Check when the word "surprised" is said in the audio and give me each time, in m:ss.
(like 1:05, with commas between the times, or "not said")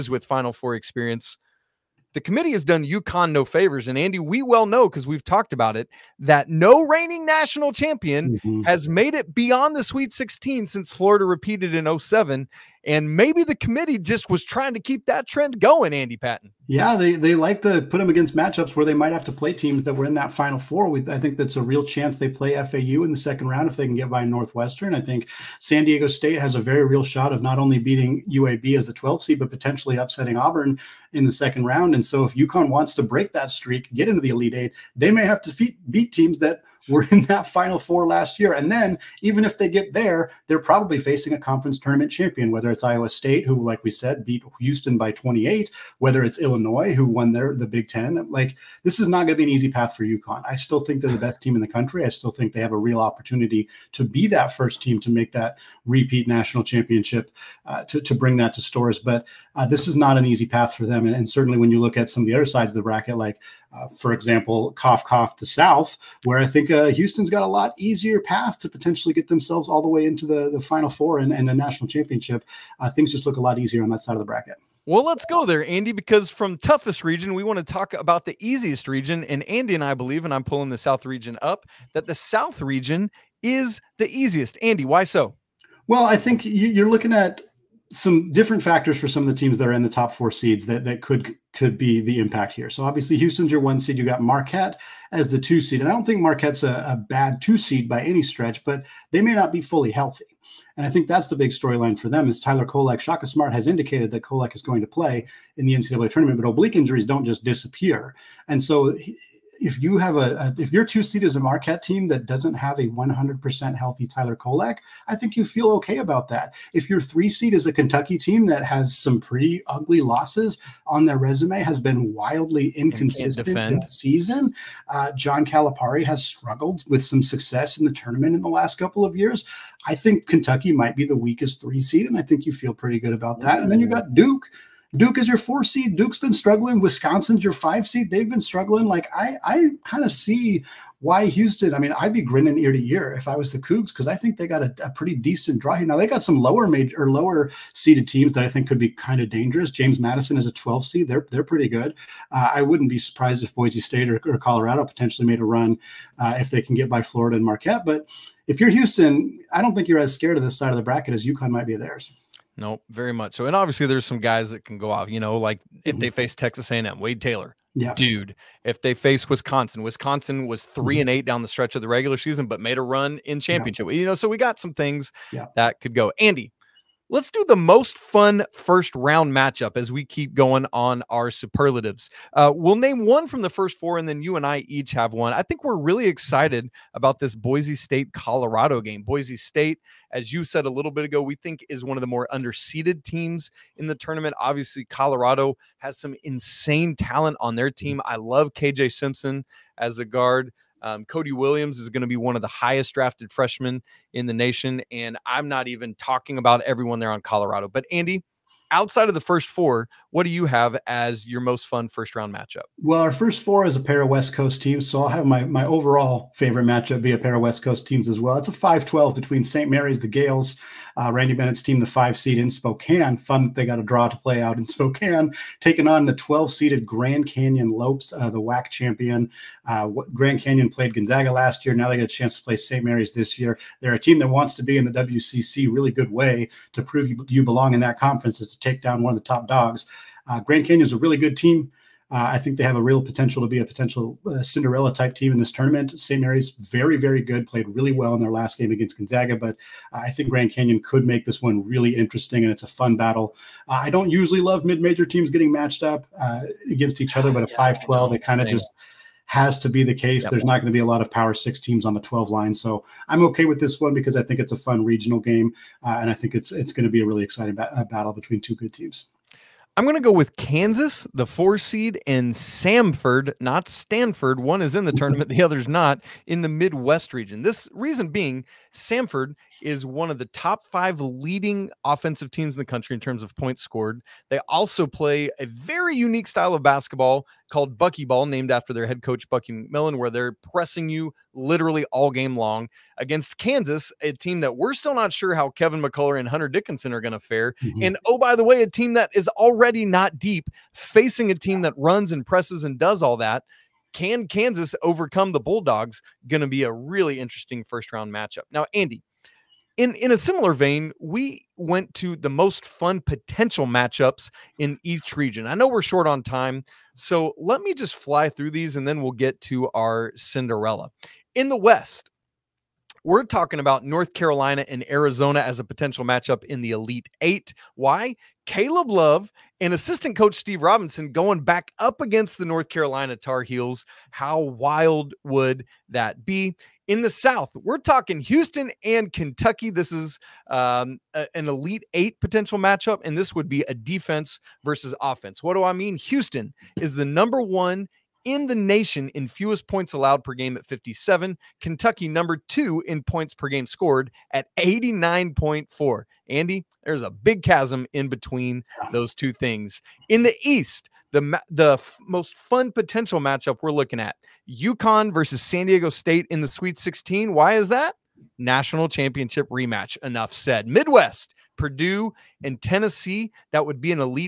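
2:32.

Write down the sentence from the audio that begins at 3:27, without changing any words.
But Andy, outside of the first four, what do you have as your most fun first round matchup?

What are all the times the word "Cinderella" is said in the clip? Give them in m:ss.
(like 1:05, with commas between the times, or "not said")
4:04, 5:20.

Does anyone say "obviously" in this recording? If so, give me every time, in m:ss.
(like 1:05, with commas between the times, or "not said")
1:32, 2:43, 3:14.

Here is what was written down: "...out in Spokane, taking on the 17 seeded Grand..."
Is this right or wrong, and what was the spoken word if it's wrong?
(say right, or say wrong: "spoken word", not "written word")
wrong: "12", not "17".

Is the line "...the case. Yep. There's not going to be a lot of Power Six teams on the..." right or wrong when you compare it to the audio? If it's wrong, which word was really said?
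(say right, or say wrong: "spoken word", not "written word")
right.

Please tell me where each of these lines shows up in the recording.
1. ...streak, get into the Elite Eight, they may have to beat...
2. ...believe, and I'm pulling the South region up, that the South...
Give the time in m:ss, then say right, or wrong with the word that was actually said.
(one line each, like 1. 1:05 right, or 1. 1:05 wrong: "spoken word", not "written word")
1. 0:33 right
2. 1:19 right.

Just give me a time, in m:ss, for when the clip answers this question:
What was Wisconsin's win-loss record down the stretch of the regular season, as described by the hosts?
2:50.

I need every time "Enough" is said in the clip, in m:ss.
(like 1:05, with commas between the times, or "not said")
6:10.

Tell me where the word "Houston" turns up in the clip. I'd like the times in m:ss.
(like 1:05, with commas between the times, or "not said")
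0:44, 1:06, 1:33, 2:21, 2:38, 5:38, 5:45.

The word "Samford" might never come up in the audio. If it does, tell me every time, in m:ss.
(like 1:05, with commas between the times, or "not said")
4:32, 4:38.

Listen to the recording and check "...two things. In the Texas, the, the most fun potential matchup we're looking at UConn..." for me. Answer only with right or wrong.
wrong.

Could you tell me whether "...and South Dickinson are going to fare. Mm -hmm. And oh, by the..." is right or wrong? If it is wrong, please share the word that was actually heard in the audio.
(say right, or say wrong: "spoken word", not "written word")
wrong: "Hunter", not "South".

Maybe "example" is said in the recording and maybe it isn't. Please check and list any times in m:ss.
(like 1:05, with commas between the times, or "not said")
1:04.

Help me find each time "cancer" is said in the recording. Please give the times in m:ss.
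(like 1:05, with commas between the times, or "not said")
not said.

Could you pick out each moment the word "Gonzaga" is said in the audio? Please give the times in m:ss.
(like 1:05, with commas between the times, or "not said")
3:50, 4:08.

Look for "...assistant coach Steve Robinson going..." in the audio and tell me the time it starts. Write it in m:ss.
5:29.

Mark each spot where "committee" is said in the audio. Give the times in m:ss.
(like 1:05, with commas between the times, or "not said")
0:02, 0:13.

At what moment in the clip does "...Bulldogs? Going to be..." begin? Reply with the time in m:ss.
5:05.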